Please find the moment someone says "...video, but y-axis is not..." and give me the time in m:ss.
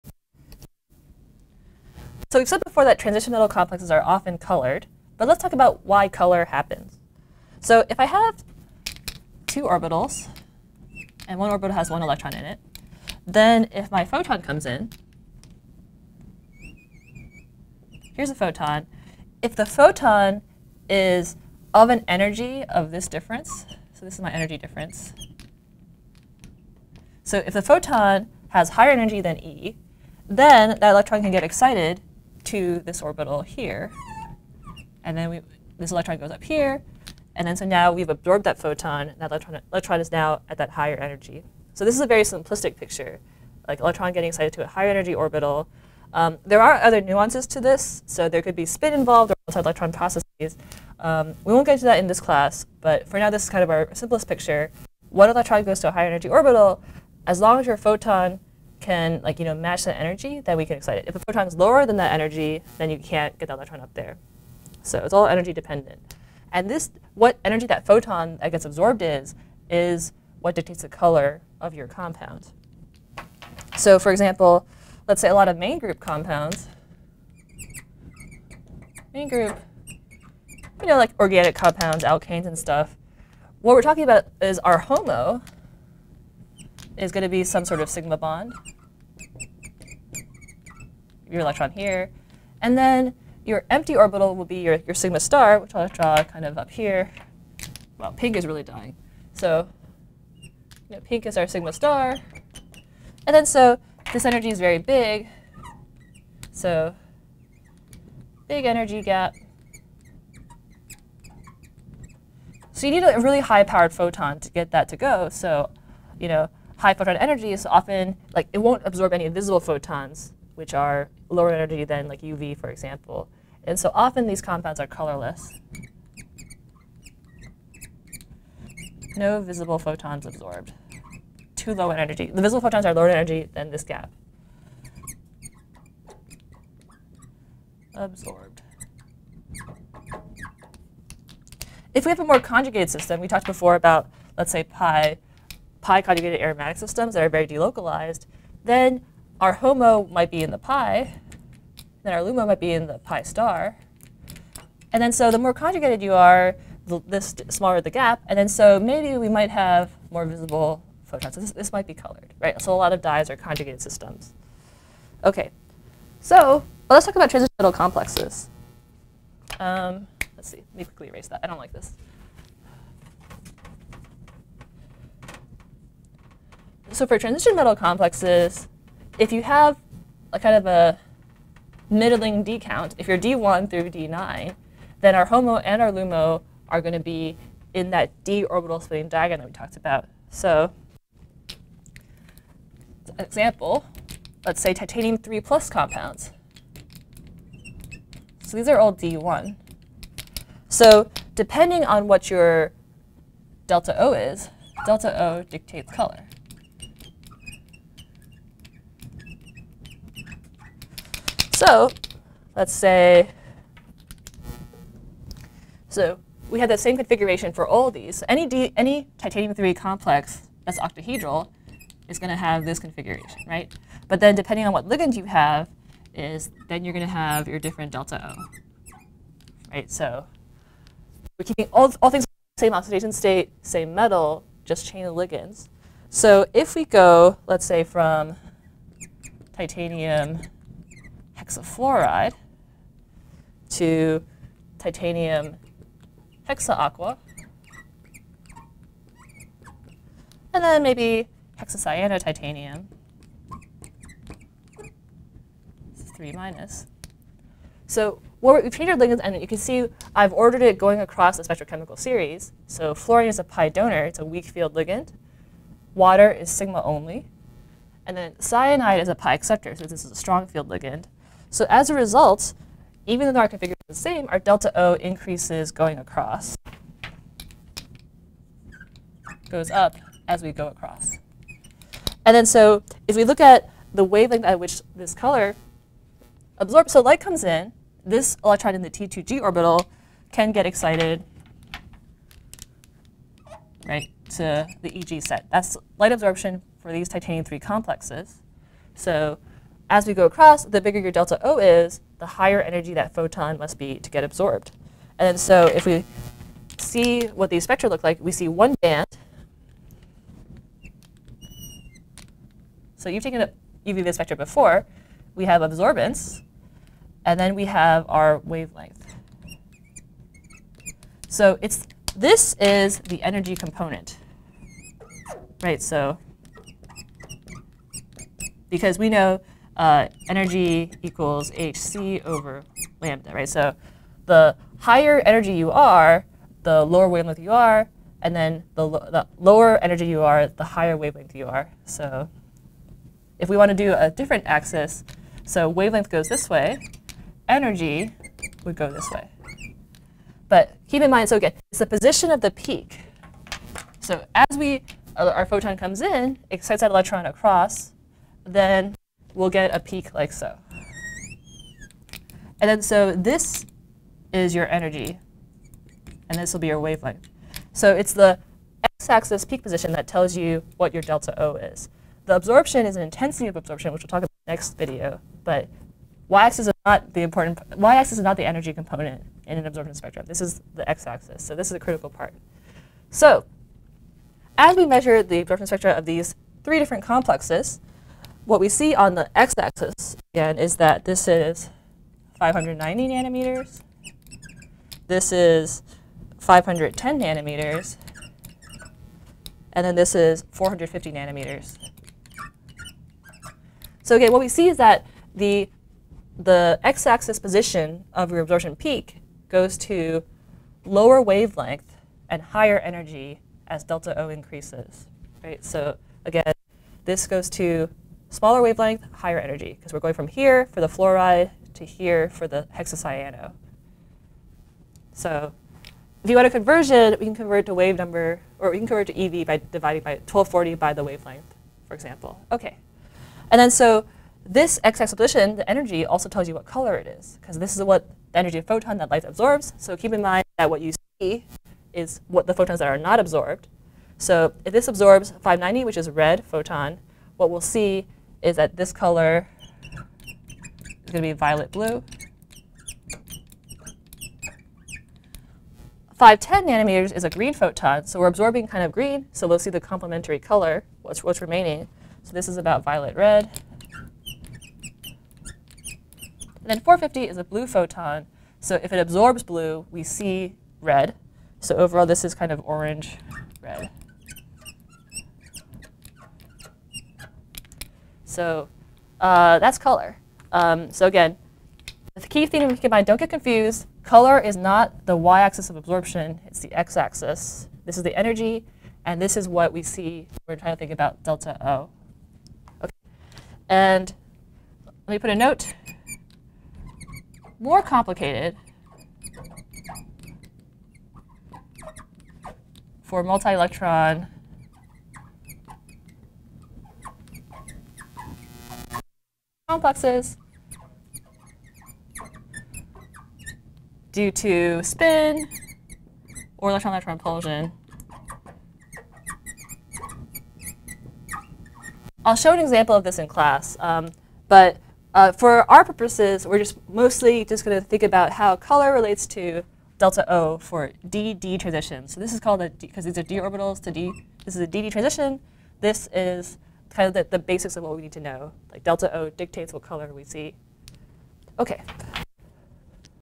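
6:14.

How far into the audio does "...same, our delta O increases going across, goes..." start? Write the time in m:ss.
4:34.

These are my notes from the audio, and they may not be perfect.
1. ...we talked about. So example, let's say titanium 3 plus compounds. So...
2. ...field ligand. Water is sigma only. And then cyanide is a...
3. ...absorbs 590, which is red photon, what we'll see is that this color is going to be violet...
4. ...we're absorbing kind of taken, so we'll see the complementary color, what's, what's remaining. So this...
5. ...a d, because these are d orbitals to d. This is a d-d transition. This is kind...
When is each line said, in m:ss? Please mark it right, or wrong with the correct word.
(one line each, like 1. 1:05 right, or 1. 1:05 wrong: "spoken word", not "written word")
1. 3:09 right
2. 4:24 right
3. 7:24 right
4. 7:38 wrong: "green", not "taken"
5. 8:52 right.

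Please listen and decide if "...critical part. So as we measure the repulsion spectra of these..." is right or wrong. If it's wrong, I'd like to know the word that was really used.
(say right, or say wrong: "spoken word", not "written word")
wrong: "absorption", not "repulsion".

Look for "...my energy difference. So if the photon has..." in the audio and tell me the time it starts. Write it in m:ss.
0:24.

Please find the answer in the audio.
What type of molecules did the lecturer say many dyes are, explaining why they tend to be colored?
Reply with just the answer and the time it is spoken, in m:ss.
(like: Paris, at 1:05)
conjugated systems, at 2:43.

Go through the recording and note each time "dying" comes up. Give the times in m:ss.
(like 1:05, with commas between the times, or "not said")
1:38.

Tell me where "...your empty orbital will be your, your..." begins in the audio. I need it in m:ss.
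1:33.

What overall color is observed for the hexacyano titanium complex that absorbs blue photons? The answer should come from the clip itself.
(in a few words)
orange red.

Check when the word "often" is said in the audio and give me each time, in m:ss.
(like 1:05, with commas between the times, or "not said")
0:04, 1:57, 2:03.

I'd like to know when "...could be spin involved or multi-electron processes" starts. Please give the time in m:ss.
0:48.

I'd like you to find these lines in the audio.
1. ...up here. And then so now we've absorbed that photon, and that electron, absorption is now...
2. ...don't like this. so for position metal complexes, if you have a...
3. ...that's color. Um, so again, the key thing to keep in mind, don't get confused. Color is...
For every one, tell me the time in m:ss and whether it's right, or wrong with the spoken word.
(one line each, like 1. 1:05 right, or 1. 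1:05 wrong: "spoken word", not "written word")
1. 0:36 wrong: "electron", not "absorption"
2. 2:51 wrong: "transition", not "position"
3. 7:59 right.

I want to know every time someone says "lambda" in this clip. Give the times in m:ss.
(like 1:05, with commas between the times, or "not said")
5:33.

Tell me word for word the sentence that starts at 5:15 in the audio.
We have absorbance, and then we have our wavelength.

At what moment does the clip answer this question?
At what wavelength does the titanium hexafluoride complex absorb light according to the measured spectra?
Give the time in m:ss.
6:32.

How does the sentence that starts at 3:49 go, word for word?
So we're keeping all, all things same oxidation state, same metal, just chain of ligands.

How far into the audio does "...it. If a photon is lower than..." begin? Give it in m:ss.
1:00.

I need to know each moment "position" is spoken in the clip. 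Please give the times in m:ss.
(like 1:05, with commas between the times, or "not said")
5:51, 6:09, 6:47, 7:15.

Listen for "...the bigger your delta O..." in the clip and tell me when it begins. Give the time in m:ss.
5:00.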